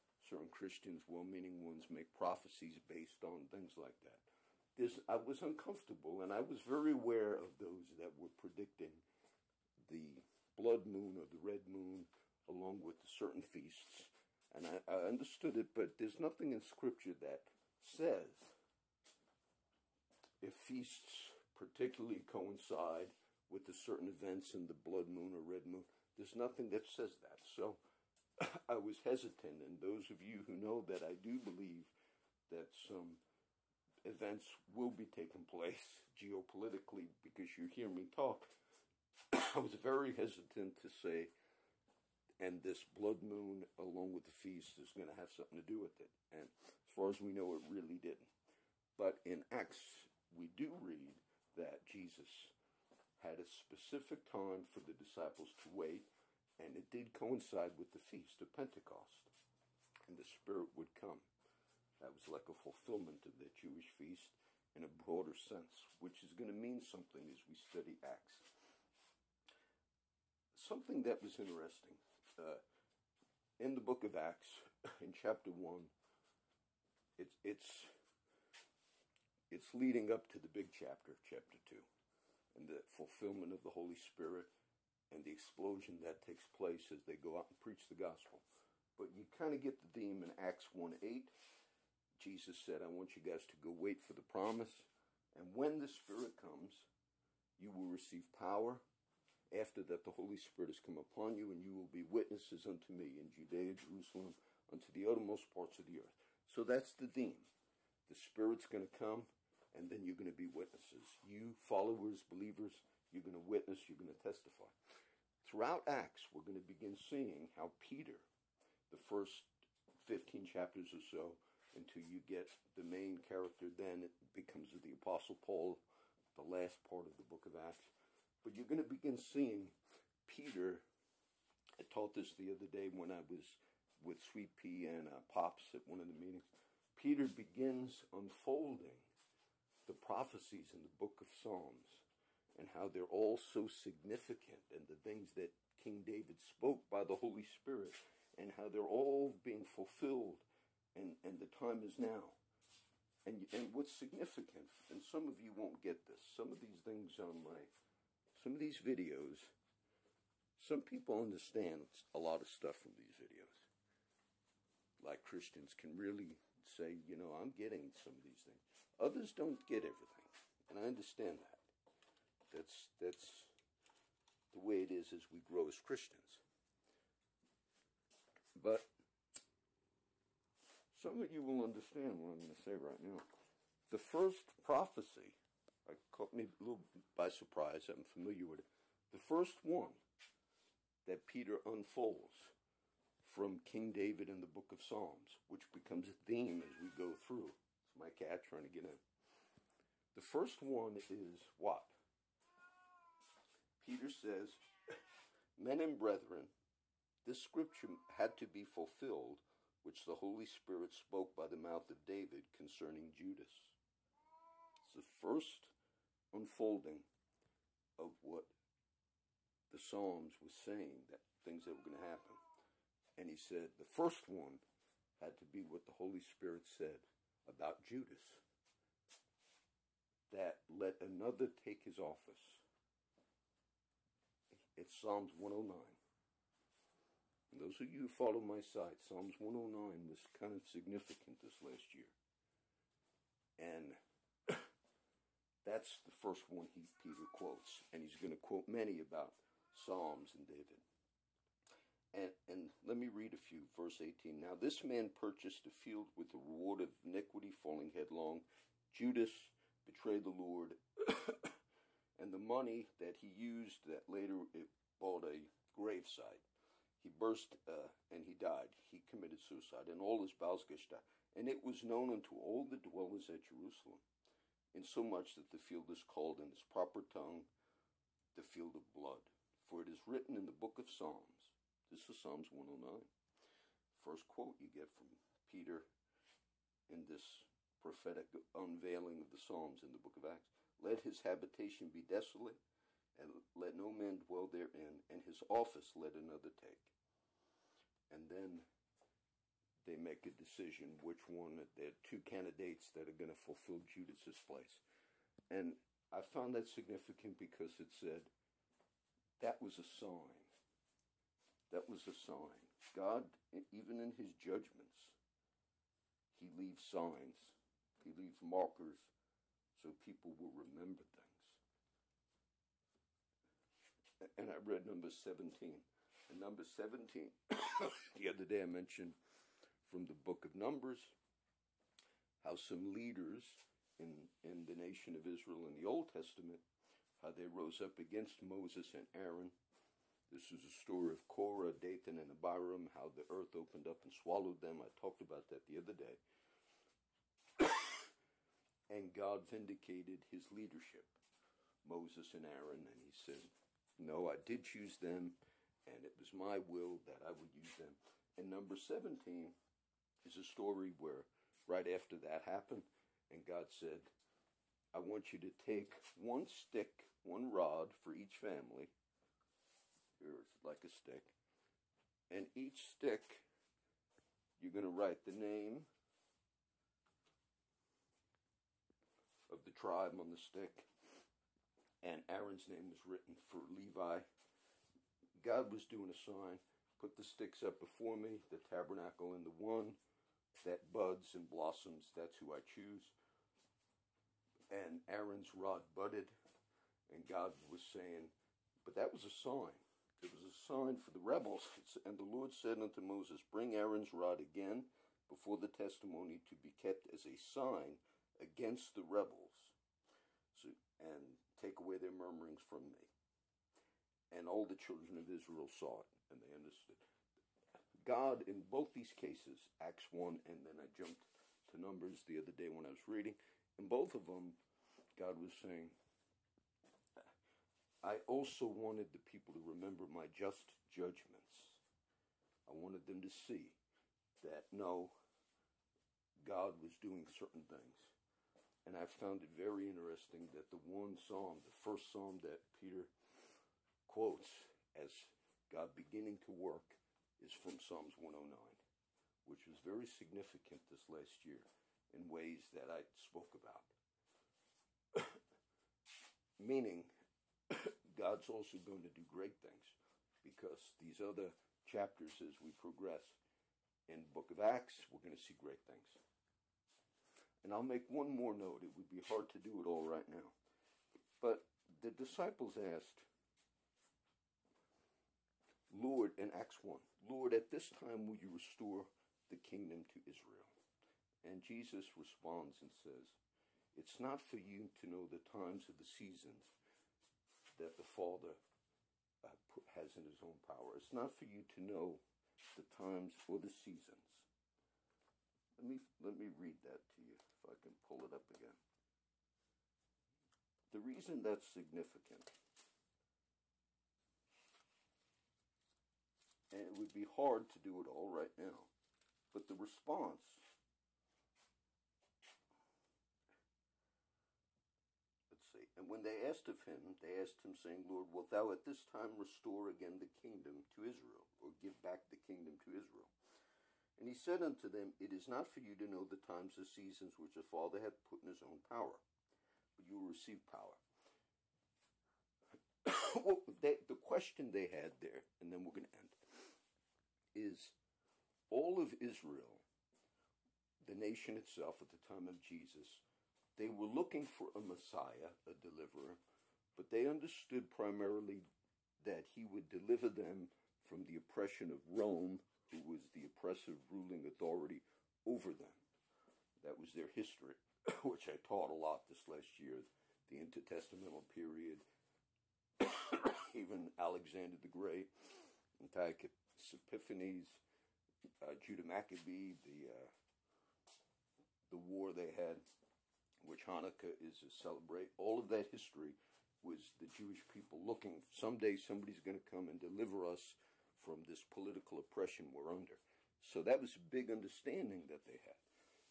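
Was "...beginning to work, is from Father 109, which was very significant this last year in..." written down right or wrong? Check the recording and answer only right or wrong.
wrong.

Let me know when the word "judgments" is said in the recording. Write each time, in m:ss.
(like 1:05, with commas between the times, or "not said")
5:14, 7:10.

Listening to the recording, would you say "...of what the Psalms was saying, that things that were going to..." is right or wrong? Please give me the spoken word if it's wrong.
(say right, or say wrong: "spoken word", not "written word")
right.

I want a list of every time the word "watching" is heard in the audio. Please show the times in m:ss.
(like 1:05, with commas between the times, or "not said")
not said.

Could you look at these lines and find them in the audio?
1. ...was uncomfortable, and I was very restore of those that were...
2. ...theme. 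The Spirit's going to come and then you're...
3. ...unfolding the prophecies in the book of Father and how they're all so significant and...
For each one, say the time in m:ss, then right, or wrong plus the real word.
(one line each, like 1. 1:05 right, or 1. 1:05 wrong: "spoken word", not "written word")
1. 0:05 wrong: "aware", not "restore"
2. 1:47 right
3. 2:18 wrong: "Psalms", not "Father".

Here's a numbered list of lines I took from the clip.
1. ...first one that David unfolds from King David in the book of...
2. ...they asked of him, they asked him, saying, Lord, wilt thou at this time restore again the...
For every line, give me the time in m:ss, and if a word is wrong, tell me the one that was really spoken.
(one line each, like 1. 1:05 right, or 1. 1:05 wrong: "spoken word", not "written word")
1. 3:09 wrong: "Peter", not "David"
2. 8:36 right.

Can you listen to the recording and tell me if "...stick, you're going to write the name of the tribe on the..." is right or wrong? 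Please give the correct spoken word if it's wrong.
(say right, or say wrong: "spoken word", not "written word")
right.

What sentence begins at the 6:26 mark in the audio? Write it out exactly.
Put the sticks up before me, the tabernacle and the one that buds and blossoms.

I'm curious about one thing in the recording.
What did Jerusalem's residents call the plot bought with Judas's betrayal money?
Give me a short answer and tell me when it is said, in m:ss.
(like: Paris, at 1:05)
the field of blood, at 4:38.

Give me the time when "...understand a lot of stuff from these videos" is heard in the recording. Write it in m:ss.
2:41.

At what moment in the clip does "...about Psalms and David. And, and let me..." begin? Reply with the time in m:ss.
4:08.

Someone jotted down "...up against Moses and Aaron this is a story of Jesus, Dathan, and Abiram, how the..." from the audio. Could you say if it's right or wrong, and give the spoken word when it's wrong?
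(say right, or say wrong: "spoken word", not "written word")
wrong: "Korah", not "Jesus".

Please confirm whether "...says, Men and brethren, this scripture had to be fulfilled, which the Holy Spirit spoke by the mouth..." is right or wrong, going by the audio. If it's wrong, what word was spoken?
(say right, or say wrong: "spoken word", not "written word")
right.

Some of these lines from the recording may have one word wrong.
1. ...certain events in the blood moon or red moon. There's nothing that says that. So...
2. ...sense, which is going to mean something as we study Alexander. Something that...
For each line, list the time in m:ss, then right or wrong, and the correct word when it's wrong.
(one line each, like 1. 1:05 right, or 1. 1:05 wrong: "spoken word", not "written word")
1. 0:23 right
2. 1:05 wrong: "Acts", not "Alexander".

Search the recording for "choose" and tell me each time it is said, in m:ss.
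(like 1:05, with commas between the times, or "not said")
5:54, 6:32.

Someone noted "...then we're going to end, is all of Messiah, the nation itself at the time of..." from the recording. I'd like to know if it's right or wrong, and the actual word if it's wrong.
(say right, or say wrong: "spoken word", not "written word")
wrong: "Israel", not "Messiah".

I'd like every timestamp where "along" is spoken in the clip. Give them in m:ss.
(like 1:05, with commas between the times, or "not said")
0:12, 0:43.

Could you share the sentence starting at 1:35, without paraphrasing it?
And when the Spirit comes, you will receive power.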